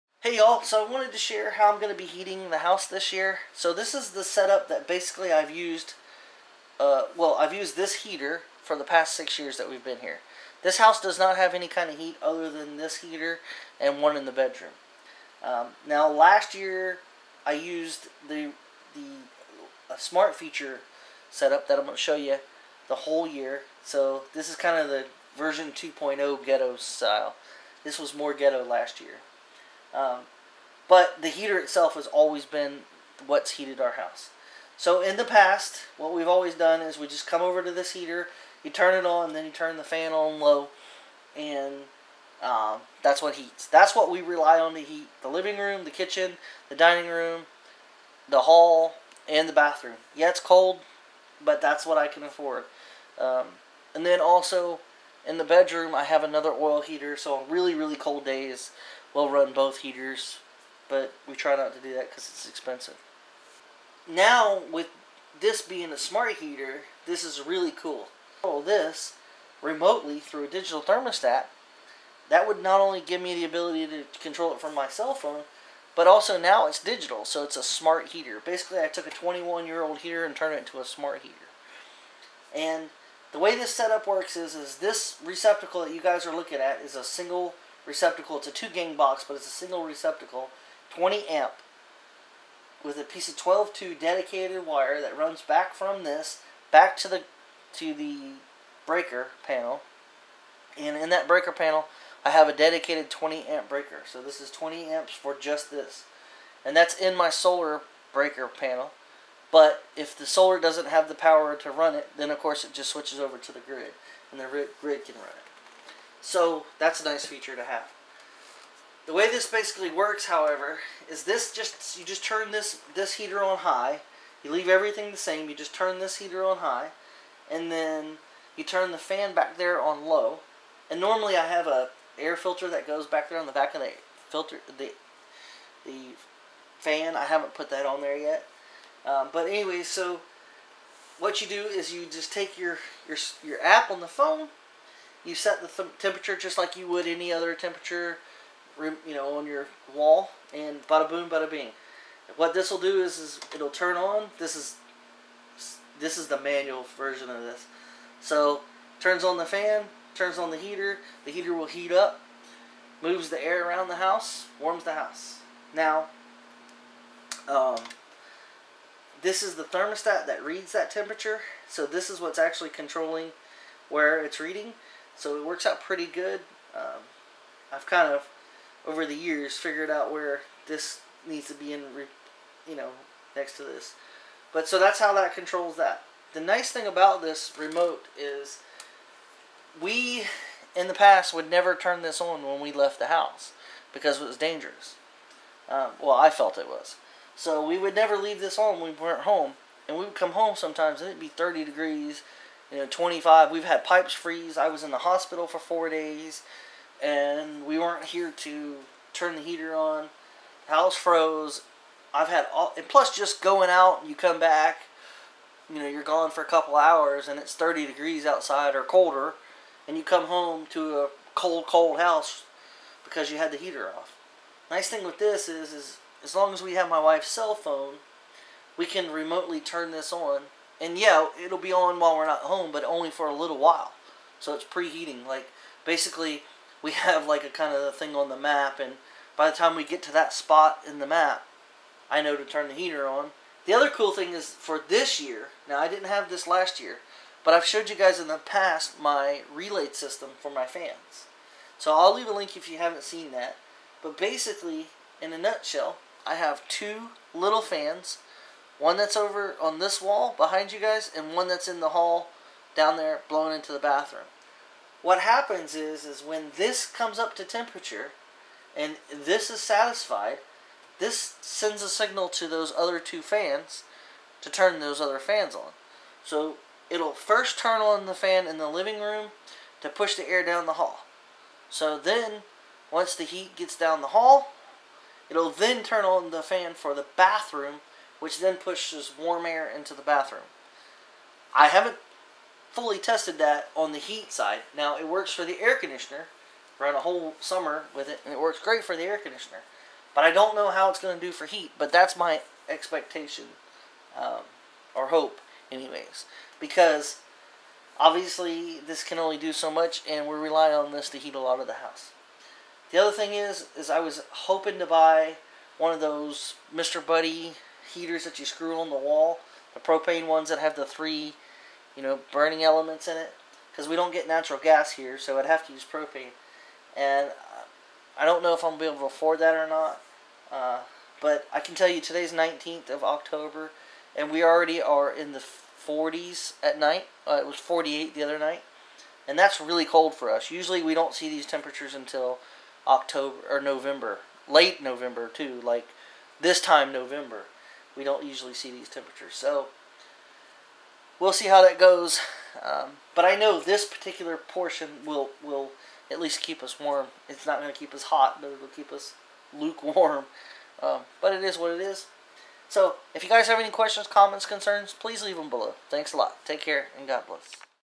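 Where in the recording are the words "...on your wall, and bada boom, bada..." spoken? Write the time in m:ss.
2:29.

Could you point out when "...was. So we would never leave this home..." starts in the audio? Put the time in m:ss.
3:16.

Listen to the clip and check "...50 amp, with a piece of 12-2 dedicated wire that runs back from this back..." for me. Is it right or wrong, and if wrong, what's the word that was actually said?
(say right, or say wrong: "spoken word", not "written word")
wrong: "20", not "50".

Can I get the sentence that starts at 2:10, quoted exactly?
And normally I have a air filter that goes back there on the back of the filter the the fan.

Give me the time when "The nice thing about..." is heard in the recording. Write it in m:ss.
3:06.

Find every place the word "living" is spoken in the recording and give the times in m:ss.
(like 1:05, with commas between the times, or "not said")
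0:45, 4:38.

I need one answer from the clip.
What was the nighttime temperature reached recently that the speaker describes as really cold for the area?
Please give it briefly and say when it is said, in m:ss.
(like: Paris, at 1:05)
48, at 5:37.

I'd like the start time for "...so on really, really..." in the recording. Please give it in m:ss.
0:57.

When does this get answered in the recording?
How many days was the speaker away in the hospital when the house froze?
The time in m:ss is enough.
3:25.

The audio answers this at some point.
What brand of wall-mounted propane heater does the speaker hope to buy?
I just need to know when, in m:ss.
5:16.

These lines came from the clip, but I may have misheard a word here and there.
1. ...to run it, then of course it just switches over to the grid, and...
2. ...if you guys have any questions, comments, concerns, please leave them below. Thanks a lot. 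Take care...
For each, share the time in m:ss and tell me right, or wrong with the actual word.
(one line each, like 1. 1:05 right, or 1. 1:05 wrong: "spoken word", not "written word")
1. 1:51 right
2. 6:03 right.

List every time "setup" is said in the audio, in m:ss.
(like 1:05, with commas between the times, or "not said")
0:04, 0:21, 1:23.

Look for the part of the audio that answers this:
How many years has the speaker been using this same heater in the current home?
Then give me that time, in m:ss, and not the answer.
0:09.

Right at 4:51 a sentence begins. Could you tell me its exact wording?
I haven't fully tested that on the heat side.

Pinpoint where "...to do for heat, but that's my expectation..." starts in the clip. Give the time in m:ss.
5:01.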